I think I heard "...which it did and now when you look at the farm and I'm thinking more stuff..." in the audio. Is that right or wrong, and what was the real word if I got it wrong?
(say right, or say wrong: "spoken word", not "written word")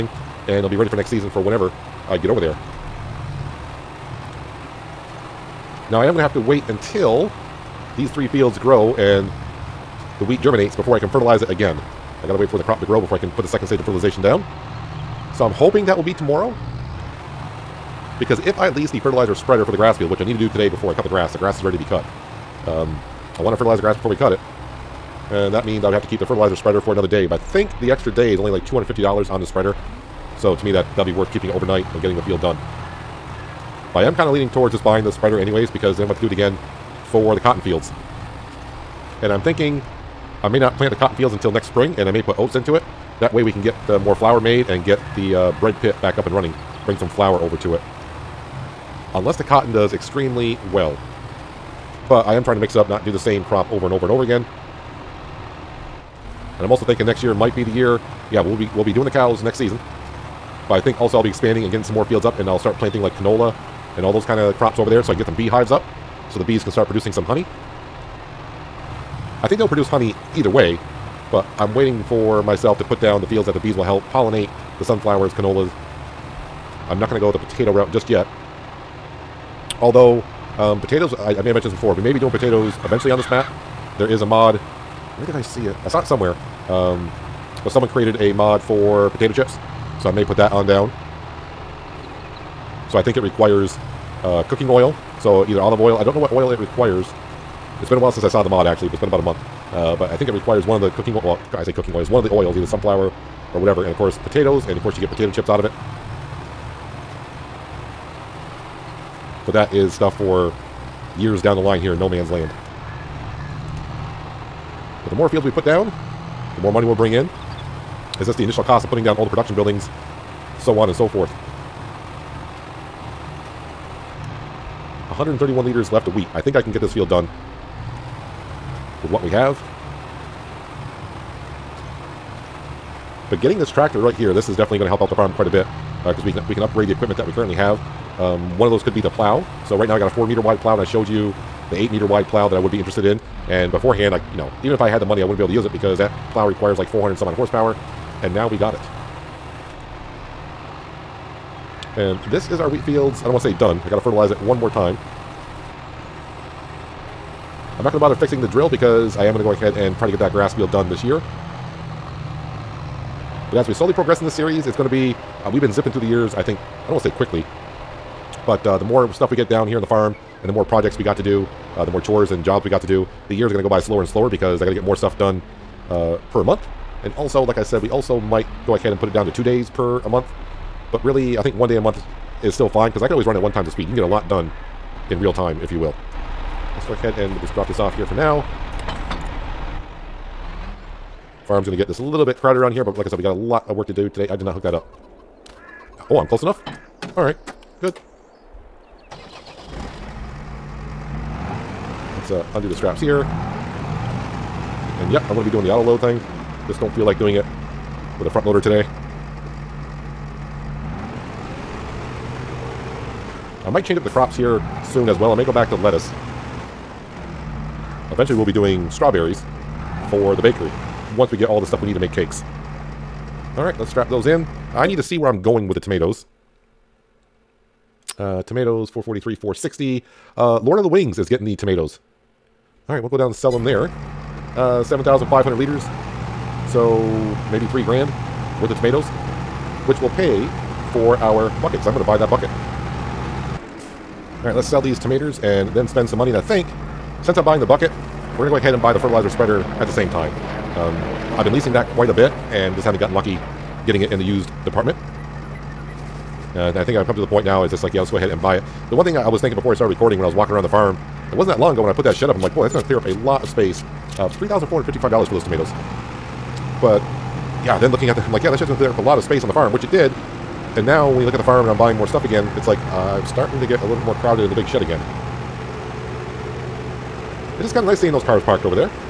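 wrong: "buying", not "thinking".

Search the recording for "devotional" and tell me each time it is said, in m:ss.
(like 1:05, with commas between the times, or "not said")
not said.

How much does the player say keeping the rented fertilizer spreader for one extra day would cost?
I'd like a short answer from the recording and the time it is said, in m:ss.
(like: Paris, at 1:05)
$250, at 0:28.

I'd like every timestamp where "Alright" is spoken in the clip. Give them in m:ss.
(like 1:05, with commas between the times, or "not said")
3:17, 3:43.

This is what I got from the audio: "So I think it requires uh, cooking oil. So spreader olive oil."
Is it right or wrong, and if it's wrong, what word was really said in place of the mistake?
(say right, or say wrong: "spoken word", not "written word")
wrong: "either", not "spreader".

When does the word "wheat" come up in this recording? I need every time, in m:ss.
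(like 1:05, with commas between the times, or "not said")
0:10, 2:06, 2:32.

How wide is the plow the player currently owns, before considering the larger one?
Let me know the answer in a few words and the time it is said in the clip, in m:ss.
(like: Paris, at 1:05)
4 meters, at 2:20.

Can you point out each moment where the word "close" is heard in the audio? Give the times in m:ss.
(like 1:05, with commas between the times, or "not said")
3:16.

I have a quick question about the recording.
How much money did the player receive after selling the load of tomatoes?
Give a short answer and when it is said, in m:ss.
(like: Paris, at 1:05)
$3,455, at 4:24.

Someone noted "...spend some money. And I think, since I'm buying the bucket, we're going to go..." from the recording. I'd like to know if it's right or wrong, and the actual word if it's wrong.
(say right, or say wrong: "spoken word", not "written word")
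right.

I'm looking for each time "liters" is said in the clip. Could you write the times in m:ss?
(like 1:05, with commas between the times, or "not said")
2:05, 3:55.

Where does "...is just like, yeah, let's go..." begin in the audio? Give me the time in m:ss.
4:17.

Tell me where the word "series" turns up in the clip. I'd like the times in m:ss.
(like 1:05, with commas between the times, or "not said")
2:44.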